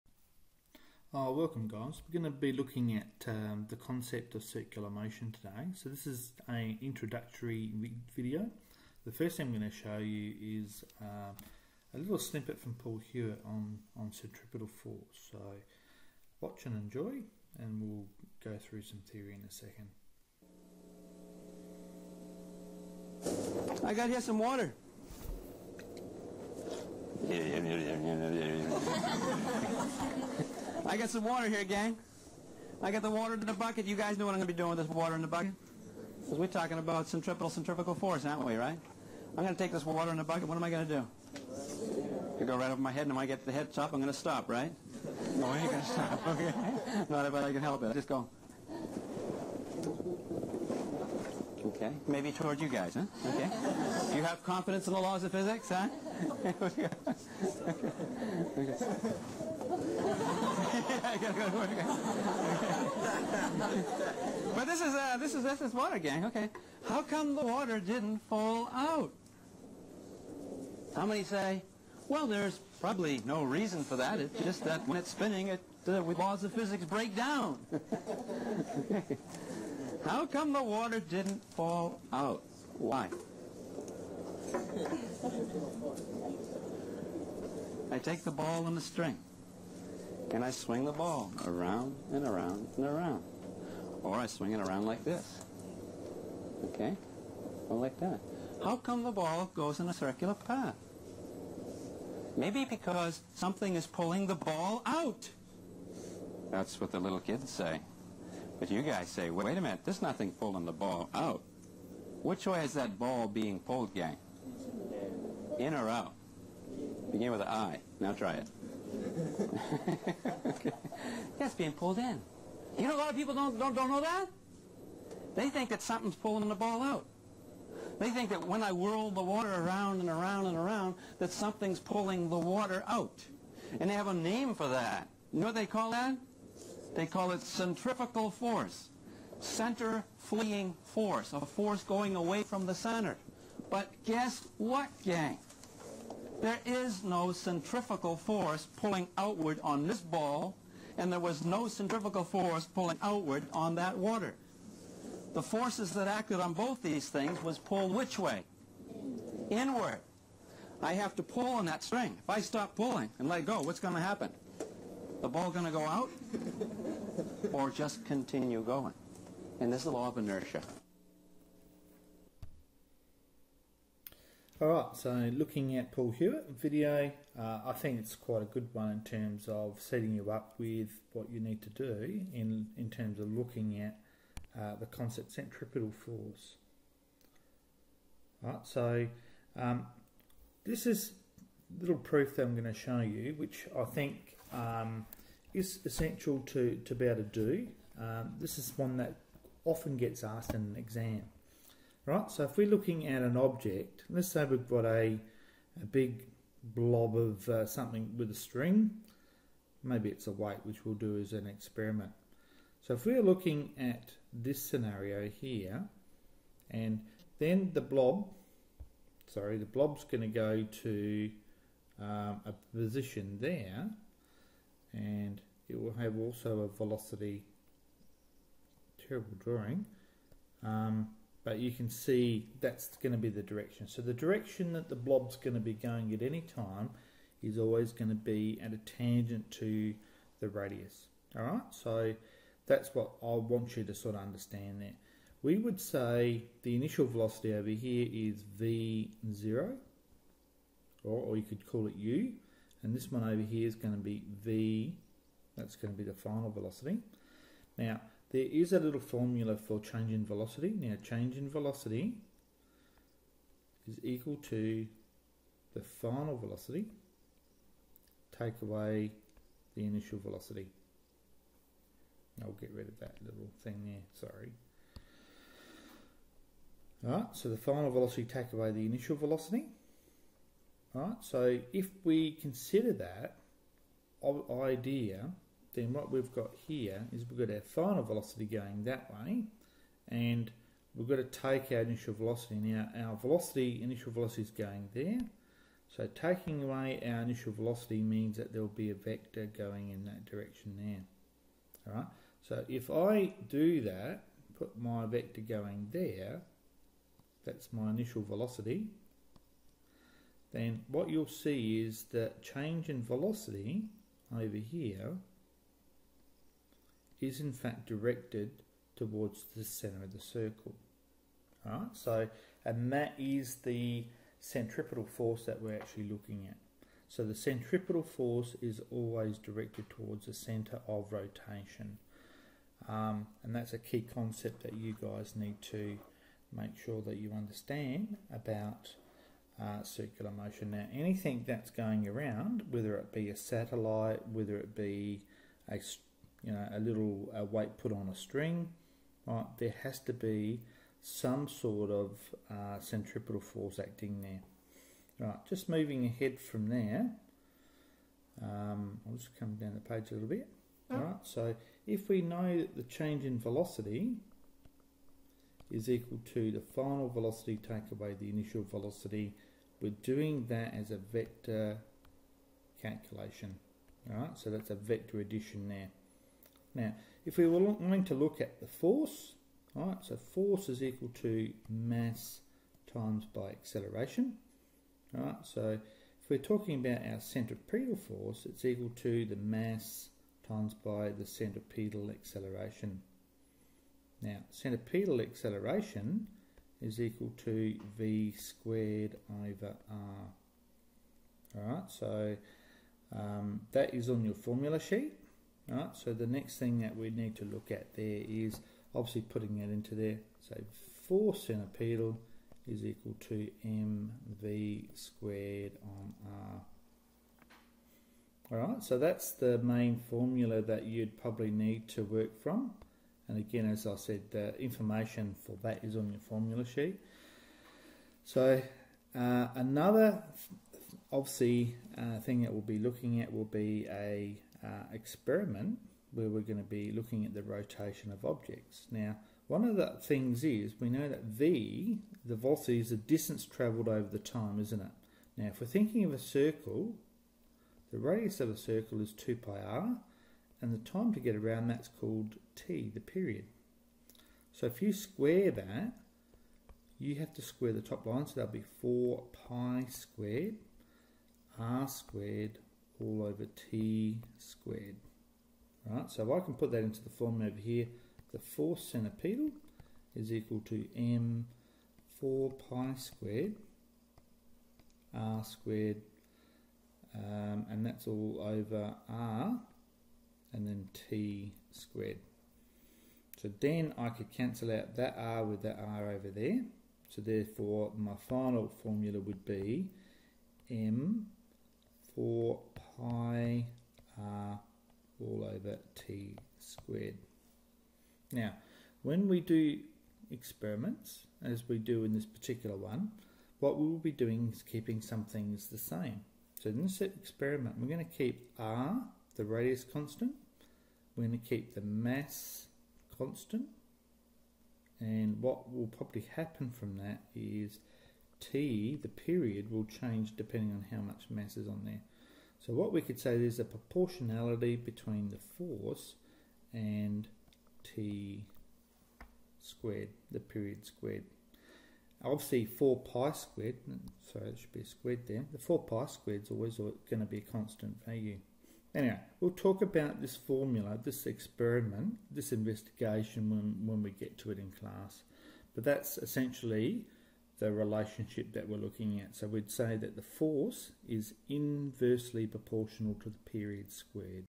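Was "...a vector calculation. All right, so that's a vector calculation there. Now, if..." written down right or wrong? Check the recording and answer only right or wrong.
wrong.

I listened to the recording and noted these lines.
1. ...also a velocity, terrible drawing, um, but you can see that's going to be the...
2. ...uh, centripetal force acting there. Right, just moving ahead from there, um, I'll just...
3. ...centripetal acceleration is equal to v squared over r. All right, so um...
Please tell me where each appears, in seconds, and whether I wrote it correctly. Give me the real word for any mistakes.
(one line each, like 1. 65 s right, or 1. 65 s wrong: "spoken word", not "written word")
1. 226 s right
2. 352 s right
3. 394 s right.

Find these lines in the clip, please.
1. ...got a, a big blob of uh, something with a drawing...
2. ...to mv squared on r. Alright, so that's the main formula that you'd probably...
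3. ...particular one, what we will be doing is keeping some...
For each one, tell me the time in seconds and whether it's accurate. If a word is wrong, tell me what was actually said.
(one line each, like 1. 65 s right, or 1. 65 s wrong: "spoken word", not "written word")
1. 204 s wrong: "string", not "drawing"
2. 413 s right
3. 502 s right.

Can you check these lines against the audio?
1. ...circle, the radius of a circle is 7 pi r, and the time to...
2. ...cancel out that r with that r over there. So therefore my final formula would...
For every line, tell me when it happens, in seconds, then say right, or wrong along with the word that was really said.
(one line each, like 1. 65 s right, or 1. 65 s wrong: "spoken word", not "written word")
1. 446 s wrong: "2", not "7"
2. 484 s right.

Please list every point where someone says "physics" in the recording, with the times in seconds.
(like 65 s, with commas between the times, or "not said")
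55 s, 76 s.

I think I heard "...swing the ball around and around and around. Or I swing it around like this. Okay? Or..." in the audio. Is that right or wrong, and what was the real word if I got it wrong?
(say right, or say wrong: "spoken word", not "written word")
right.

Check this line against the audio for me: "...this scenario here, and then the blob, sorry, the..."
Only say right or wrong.
right.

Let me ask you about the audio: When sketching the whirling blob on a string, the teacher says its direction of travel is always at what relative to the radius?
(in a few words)
a tangent.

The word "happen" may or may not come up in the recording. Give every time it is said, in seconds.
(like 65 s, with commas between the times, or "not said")
164 s, 516 s.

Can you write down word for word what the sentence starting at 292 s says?
Now our velocity, initial velocity is going there.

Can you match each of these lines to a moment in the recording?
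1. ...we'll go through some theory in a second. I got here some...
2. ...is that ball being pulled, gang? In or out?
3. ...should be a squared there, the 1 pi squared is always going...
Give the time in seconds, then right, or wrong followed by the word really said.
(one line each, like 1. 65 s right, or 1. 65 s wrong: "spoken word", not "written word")
1. 17 s right
2. 112 s right
3. 534 s wrong: "4", not "1".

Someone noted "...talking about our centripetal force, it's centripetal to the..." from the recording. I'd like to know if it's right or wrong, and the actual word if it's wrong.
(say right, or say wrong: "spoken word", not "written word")
wrong: "equal", not "centripetal".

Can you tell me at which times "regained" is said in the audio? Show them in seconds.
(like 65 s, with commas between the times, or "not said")
not said.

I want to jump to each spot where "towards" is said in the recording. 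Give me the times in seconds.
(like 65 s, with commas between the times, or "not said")
52 s, 318 s, 329 s.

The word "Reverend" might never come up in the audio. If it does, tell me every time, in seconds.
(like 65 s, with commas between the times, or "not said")
not said.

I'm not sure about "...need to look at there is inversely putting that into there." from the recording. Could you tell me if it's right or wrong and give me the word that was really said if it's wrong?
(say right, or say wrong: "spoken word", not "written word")
wrong: "obviously", not "inversely".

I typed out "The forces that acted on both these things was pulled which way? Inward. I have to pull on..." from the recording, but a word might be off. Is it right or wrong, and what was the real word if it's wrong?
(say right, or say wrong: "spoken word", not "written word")
right.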